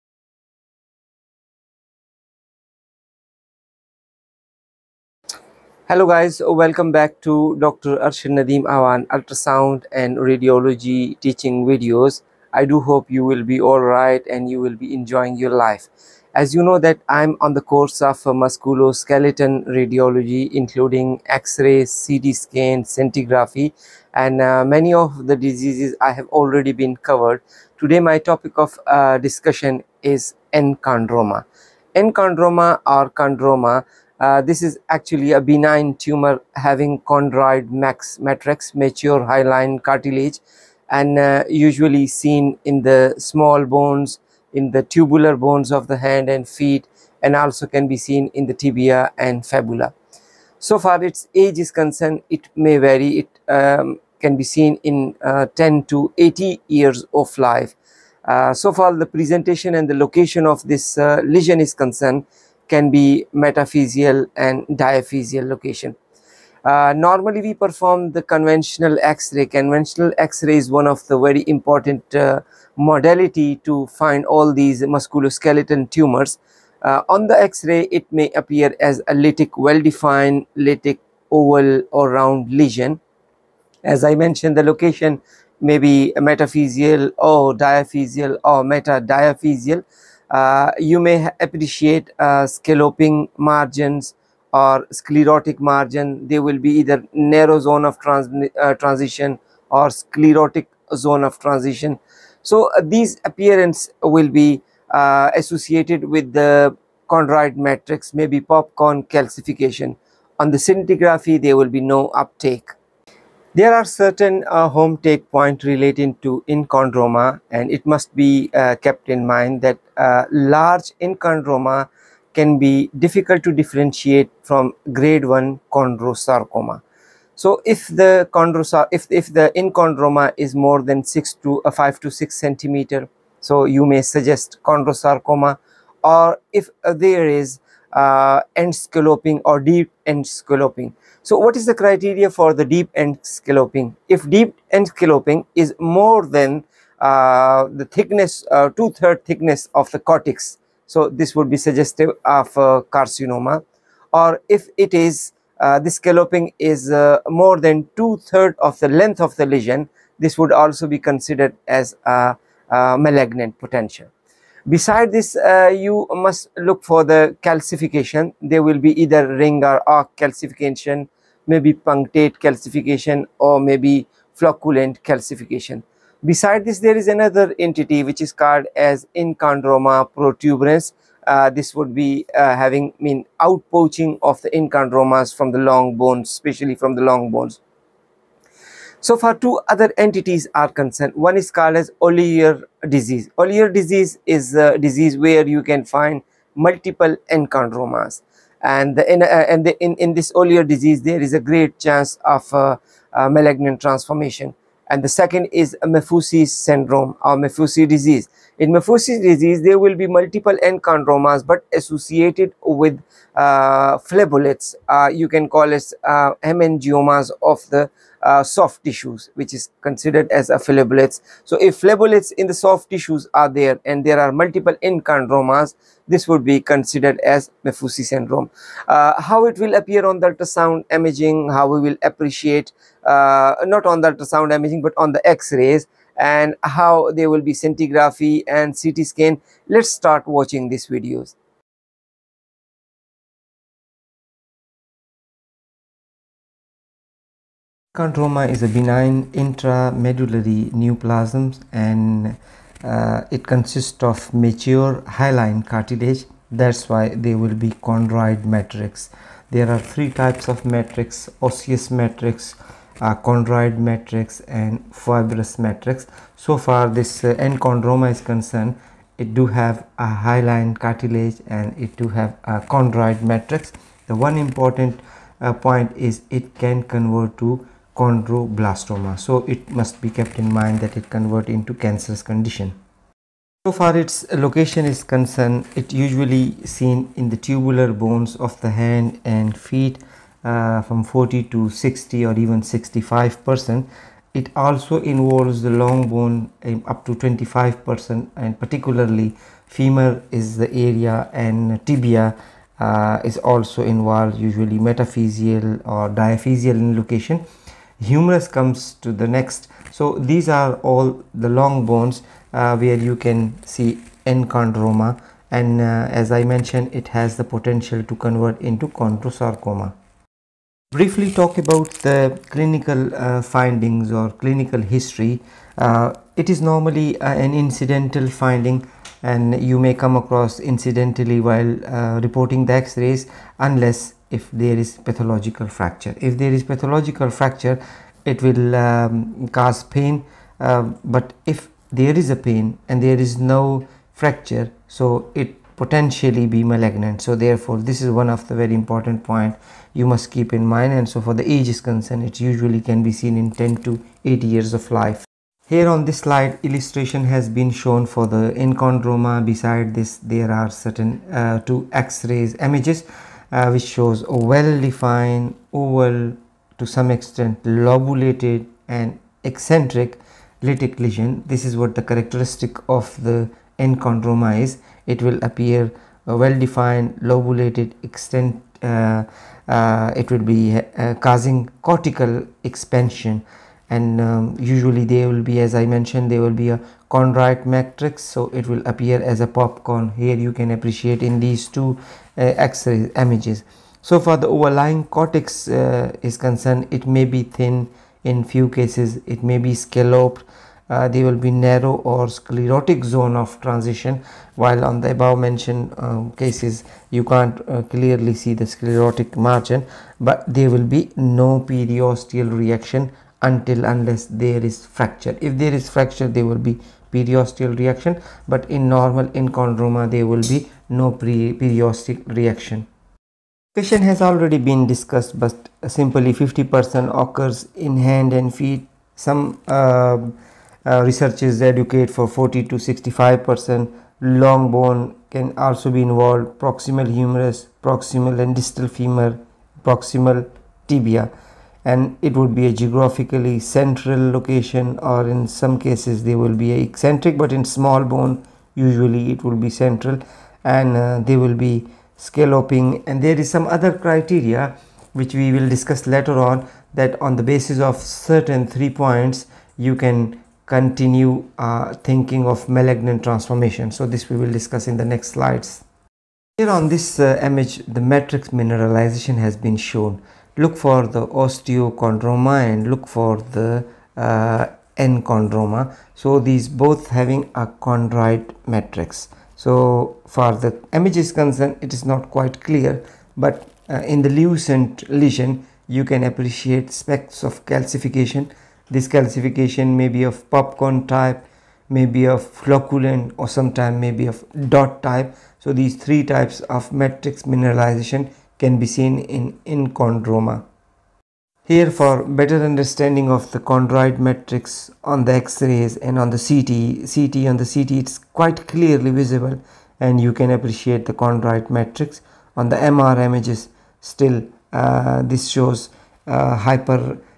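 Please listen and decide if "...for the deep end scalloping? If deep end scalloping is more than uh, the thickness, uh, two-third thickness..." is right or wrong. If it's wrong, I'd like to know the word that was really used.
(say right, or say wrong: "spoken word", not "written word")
right.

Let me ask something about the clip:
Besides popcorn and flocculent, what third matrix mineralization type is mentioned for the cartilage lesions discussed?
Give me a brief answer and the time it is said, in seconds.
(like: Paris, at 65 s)
dot type, at 494 s.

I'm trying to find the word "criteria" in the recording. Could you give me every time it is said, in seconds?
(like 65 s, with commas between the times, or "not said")
141 s, 453 s.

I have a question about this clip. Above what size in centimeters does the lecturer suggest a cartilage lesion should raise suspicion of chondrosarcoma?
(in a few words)
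5 to 6 centimeters.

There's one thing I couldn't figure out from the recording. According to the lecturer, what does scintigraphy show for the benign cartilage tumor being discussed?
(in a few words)
no uptake.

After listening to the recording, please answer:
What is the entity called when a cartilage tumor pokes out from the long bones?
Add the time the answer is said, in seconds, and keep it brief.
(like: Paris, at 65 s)
enchondroma protuberance, at 179 s.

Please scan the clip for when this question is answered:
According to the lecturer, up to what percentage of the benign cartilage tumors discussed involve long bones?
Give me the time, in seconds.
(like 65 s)
297 s.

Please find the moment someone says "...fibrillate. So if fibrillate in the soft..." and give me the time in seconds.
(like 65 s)
220 s.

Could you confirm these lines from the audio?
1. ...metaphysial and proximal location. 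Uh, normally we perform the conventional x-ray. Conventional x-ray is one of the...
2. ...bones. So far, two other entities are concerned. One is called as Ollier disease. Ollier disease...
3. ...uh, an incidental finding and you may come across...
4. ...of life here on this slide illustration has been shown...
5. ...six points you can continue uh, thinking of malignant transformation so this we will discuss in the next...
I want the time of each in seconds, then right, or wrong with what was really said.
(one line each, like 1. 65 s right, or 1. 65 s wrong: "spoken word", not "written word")
1. 63 s wrong: "diaphysial", not "proximal"
2. 187 s right
3. 327 s right
4. 354 s right
5. 458 s wrong: "three", not "six".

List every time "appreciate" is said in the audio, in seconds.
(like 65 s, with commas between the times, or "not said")
91 s, 232 s, 390 s, 486 s, 510 s.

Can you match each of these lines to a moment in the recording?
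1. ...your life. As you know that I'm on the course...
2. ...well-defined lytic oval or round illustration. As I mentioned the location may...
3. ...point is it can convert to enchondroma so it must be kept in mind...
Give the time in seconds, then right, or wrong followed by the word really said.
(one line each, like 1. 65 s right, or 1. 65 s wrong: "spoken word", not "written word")
1. 15 s right
2. 79 s wrong: "lesion", not "illustration"
3. 275 s wrong: "chondroblastoma", not "enchondroma".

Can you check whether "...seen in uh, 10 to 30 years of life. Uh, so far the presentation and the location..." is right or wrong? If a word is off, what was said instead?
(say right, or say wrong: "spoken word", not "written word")
wrong: "80", not "30".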